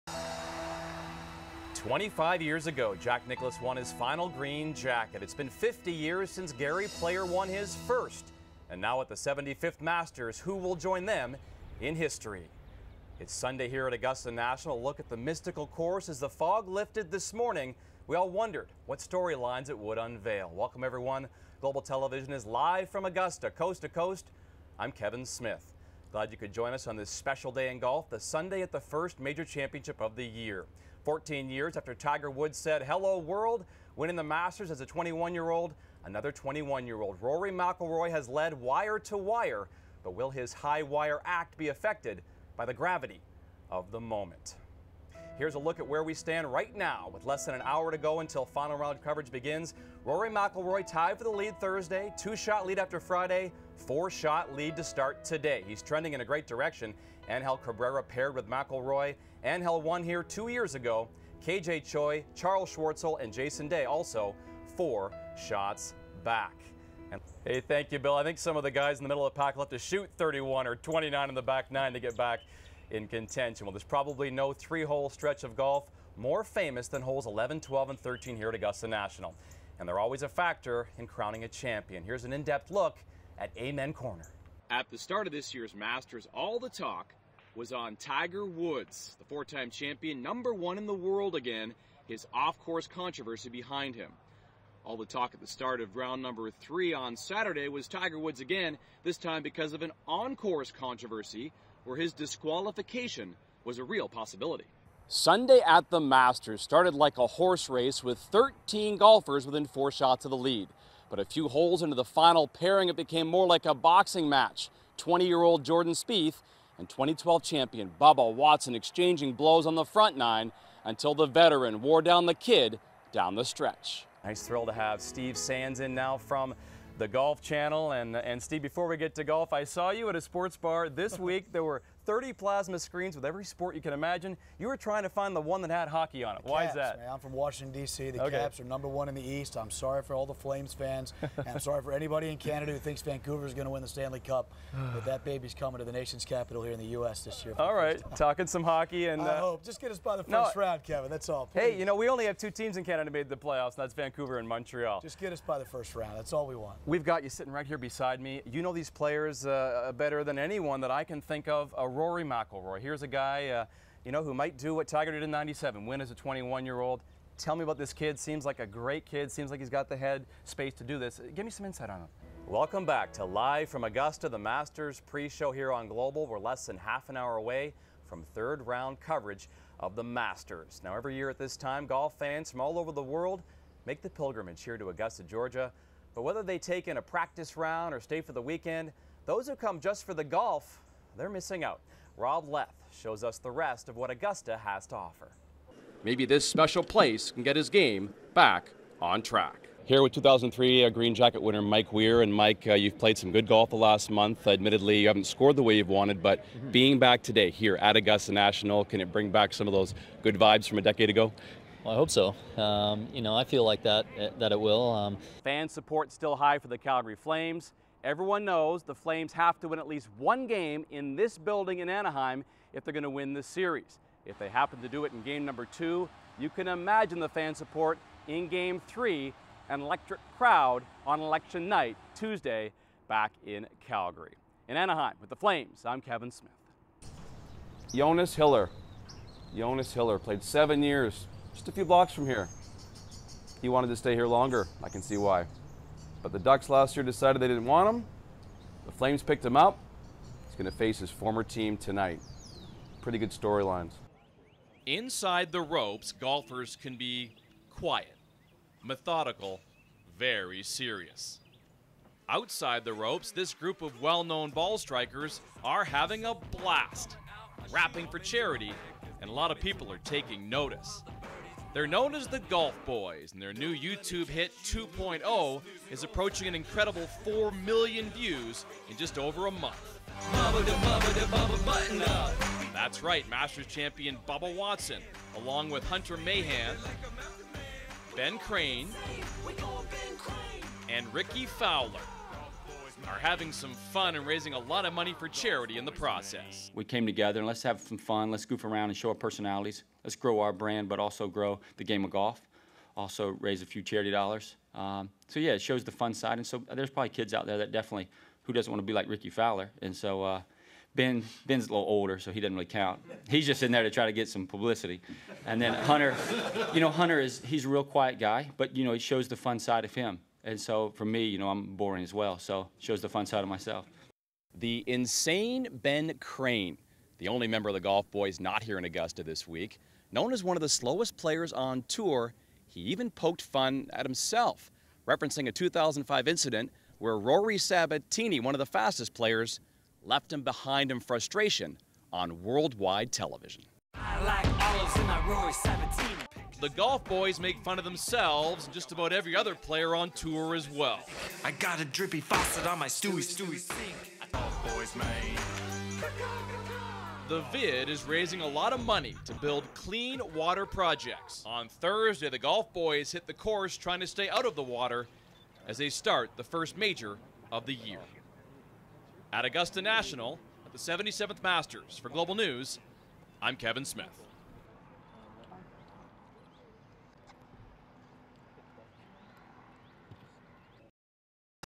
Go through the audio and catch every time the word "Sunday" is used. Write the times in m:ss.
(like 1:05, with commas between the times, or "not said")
0:13, 0:28, 1:45.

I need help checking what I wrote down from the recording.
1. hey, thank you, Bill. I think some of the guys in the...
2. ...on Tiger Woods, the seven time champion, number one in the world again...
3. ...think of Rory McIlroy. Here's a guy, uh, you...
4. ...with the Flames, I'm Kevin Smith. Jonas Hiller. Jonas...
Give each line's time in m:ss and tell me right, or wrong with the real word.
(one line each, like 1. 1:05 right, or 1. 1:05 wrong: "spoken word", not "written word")
1. 1:07 right
2. 1:27 wrong: "four", not "seven"
3. 2:41 right
4. 3:55 right.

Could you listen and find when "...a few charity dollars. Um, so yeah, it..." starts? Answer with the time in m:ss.
5:03.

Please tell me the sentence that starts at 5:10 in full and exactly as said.
Uh, Ben Ben's a little older, so he doesn't really count.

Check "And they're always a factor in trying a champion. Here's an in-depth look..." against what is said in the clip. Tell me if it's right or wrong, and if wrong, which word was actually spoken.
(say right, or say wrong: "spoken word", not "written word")
wrong: "crowning", not "trying".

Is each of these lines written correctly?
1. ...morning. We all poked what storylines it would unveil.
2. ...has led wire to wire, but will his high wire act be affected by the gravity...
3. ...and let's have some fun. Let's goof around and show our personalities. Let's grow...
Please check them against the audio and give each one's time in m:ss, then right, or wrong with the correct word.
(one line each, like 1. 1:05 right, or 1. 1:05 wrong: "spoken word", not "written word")
1. 0:17 wrong: "wondered", not "poked"
2. 0:38 right
3. 4:57 right.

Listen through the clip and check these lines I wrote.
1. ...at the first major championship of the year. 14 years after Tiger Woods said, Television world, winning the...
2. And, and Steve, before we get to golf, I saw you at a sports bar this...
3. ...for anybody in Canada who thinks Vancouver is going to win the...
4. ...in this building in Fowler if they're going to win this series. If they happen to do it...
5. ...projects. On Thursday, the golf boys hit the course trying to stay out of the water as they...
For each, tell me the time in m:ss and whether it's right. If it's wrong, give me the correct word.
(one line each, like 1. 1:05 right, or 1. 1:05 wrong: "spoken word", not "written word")
1. 0:28 wrong: "Hello", not "Television"
2. 2:07 right
3. 2:21 right
4. 3:40 wrong: "Anaheim", not "Fowler"
5. 6:00 right.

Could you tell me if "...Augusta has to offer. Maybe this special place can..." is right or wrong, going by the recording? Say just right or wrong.
right.